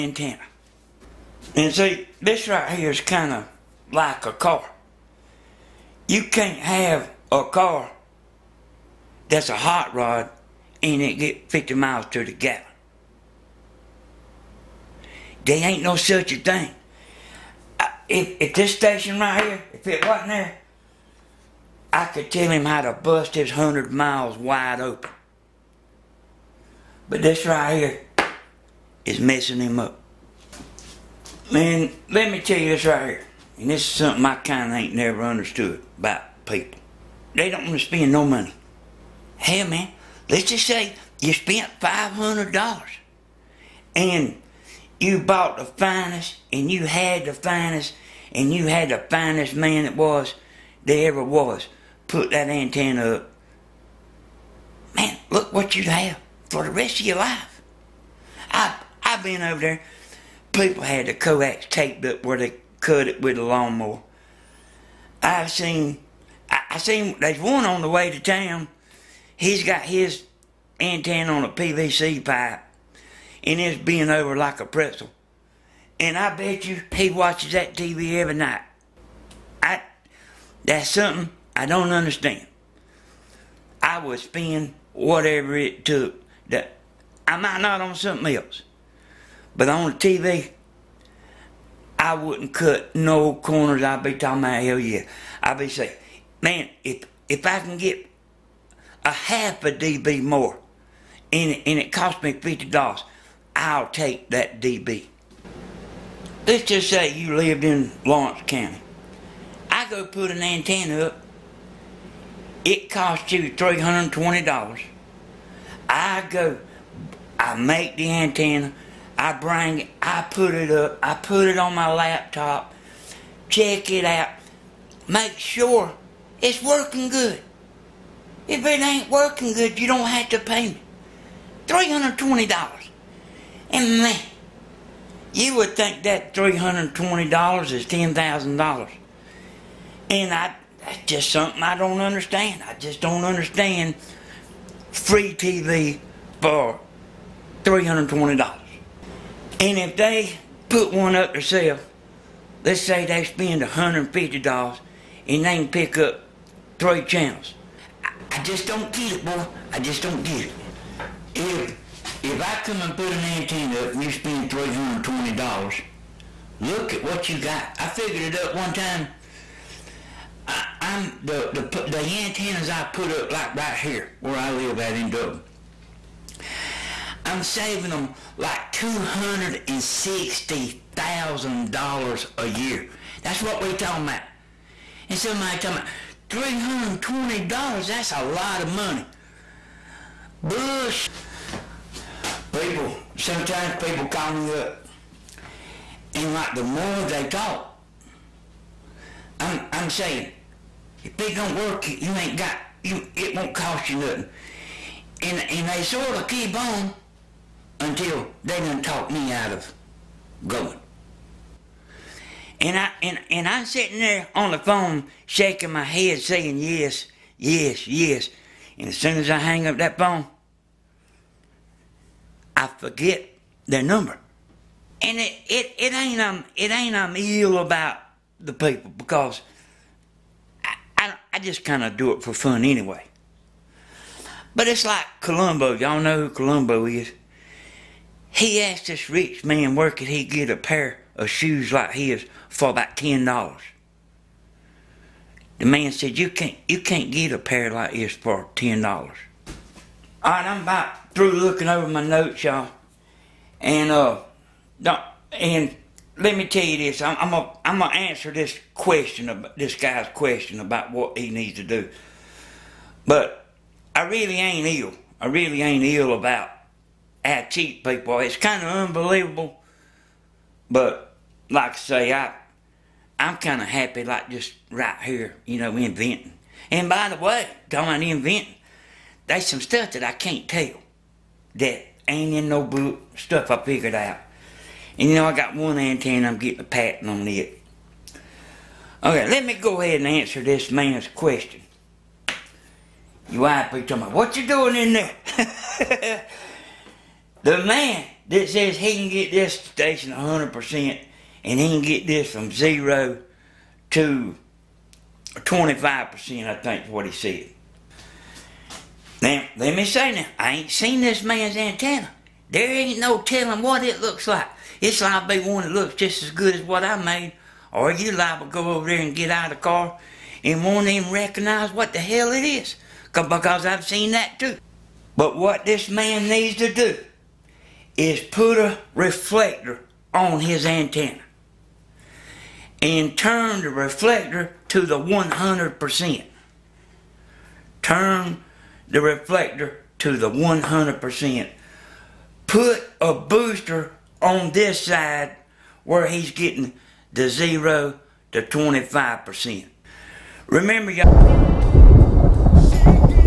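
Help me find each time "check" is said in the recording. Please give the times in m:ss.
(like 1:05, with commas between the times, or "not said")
2:03.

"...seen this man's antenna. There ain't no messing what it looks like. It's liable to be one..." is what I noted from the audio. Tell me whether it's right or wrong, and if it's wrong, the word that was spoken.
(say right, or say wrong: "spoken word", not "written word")
wrong: "telling", not "messing".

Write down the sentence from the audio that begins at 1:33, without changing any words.
I'd be talking about hell yeah.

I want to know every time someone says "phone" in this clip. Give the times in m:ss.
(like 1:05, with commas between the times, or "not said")
3:34, 3:39.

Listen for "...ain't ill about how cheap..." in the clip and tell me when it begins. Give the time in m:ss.
4:25.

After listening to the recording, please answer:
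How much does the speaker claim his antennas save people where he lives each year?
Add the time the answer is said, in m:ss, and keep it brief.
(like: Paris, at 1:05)
$260,000, at 2:58.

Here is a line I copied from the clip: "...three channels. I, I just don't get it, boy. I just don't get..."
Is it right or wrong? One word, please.
right.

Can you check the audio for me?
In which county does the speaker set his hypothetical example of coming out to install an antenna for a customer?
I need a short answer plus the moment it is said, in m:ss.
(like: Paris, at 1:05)
Laurens County, at 1:48.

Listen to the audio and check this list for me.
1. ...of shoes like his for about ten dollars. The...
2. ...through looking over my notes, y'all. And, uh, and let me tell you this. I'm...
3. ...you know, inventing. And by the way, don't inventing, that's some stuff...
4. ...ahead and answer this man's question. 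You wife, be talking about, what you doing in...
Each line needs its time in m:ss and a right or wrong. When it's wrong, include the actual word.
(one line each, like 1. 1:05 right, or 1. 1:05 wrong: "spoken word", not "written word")
1. 4:01 right
2. 4:11 right
3. 4:35 right
4. 4:49 right.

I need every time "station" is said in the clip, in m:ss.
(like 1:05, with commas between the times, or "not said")
0:18, 4:59.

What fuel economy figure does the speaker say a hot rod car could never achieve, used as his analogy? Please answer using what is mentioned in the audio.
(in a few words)
50 miles to the gallon.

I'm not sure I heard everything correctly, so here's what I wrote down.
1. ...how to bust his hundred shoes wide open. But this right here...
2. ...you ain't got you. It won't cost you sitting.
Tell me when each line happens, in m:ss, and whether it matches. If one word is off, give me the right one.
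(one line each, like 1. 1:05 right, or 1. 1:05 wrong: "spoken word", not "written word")
1. 0:22 wrong: "miles", not "shoes"
2. 3:22 wrong: "nothing", not "sitting".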